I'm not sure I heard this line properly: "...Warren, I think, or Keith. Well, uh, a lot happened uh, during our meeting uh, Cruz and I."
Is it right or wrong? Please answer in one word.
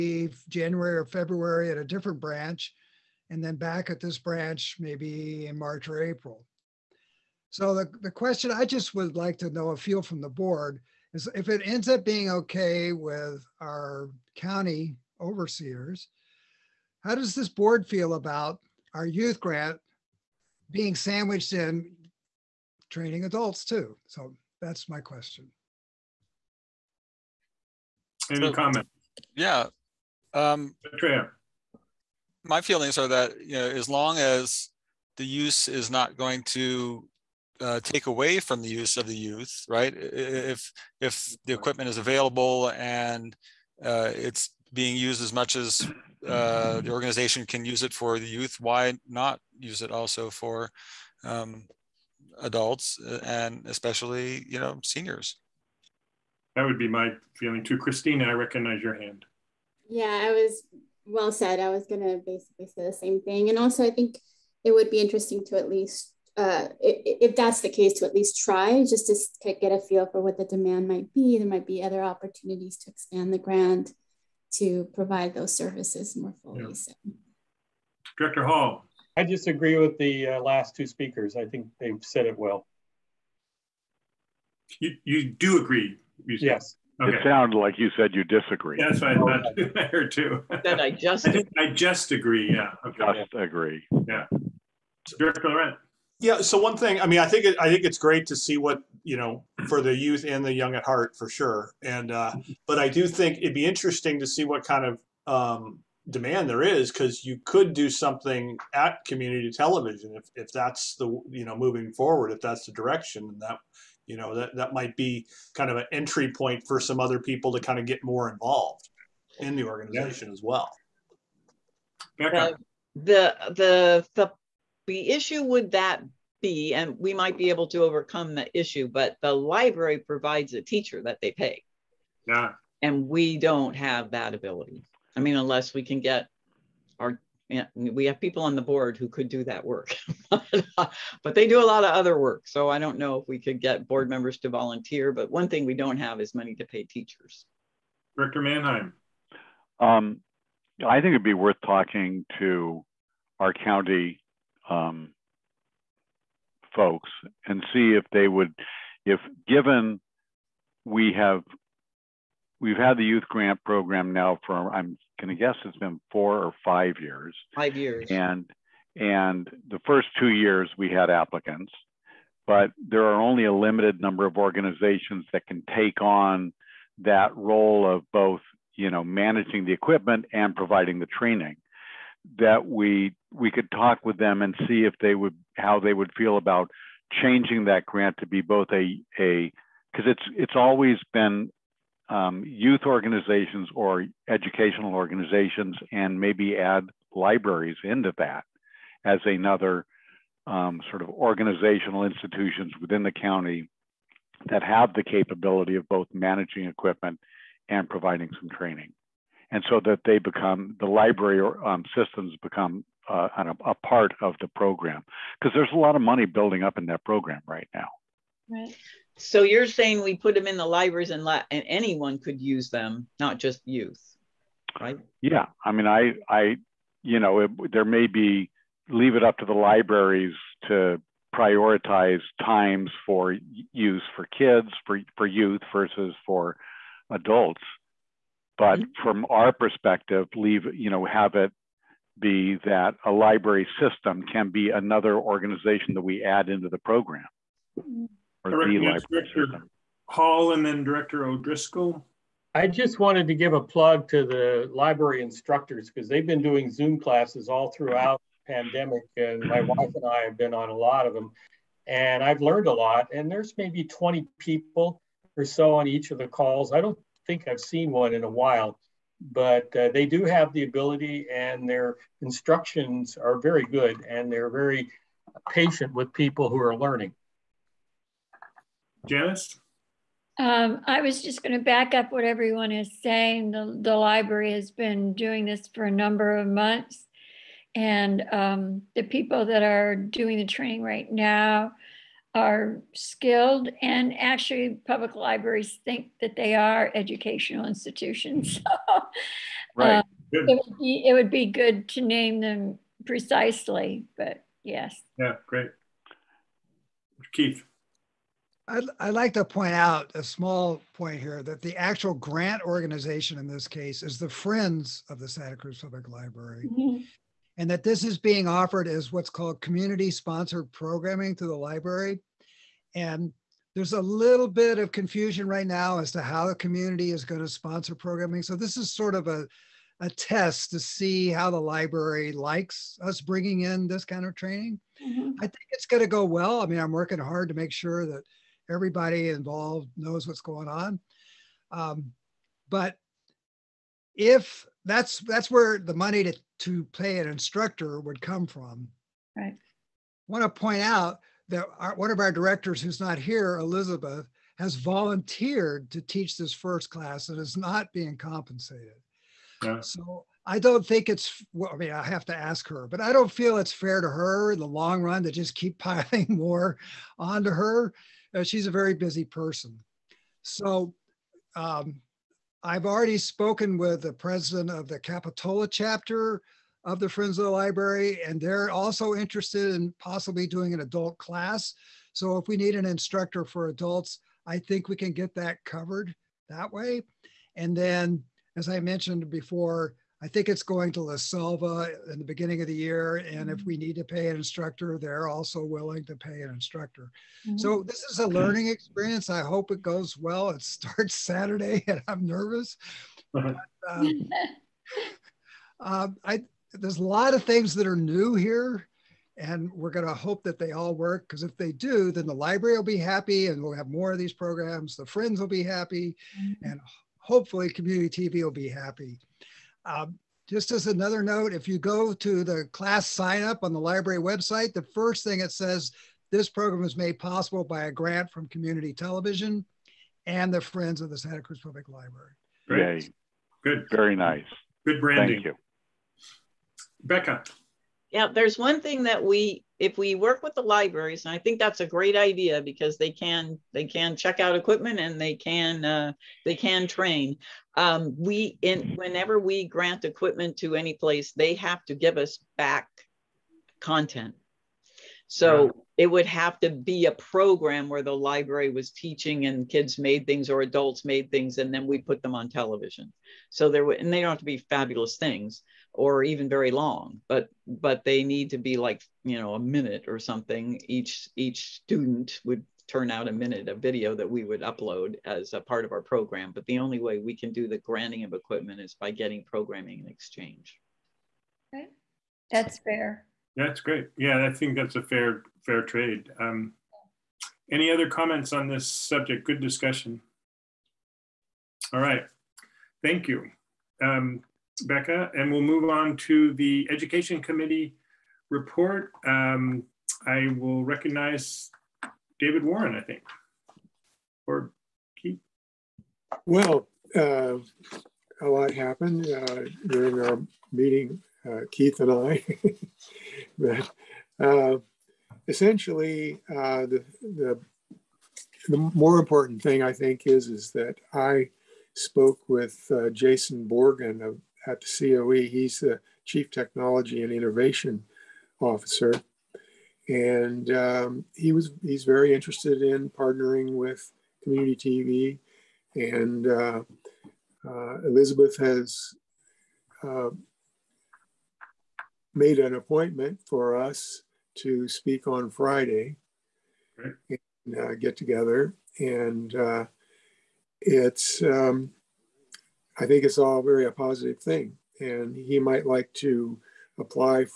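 wrong.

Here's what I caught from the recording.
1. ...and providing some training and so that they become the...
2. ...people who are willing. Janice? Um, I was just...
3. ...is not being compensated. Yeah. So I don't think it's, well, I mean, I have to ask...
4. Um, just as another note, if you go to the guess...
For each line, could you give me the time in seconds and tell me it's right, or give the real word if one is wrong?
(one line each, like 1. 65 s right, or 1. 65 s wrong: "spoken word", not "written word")
1. 207 s right
2. 276 s wrong: "learning", not "willing"
3. 357 s right
4. 419 s wrong: "class", not "guess".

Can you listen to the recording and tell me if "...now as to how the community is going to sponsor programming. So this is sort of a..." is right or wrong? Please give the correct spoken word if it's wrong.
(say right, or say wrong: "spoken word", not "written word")
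right.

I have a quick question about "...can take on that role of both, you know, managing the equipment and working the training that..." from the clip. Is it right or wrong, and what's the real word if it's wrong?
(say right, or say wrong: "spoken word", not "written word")
wrong: "providing", not "working".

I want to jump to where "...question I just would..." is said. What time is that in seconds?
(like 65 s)
8 s.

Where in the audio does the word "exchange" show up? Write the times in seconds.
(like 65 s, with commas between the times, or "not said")
480 s.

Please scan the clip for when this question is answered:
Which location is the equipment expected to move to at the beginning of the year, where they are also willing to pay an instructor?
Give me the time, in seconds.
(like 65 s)
391 s.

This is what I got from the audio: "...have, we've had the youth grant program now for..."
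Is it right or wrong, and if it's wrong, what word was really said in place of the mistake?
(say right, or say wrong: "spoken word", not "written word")
right.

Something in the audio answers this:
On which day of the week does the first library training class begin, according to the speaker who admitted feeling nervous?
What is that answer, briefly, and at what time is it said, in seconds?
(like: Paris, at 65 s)
Saturday, at 401 s.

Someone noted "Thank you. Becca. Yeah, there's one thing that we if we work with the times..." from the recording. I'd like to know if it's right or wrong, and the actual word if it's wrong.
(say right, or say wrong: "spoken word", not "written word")
wrong: "libraries", not "times".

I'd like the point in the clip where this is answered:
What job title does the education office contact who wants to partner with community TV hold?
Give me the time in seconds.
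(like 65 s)
526 s.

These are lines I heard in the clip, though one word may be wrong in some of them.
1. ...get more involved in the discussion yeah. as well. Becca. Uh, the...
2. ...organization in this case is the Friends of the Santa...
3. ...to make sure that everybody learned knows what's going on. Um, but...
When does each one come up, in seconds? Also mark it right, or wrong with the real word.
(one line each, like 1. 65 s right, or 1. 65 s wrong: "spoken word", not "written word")
1. 117 s wrong: "organization", not "discussion"
2. 312 s right
3. 337 s wrong: "involved", not "learned".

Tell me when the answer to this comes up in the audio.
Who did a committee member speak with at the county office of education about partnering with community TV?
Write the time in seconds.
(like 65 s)
523 s.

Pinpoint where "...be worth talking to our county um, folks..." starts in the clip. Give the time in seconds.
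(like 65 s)
151 s.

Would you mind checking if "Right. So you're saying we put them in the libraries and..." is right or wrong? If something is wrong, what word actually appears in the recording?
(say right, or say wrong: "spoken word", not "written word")
right.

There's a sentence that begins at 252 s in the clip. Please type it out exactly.
I just wanted to give a plug to the library instructors because they've been doing Zoom classes all throughout the pandemic.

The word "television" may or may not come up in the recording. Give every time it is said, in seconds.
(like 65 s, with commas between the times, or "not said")
109 s, 428 s, 462 s.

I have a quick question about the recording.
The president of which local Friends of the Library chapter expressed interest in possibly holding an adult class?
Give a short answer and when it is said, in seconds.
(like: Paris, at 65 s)
Capitola, at 374 s.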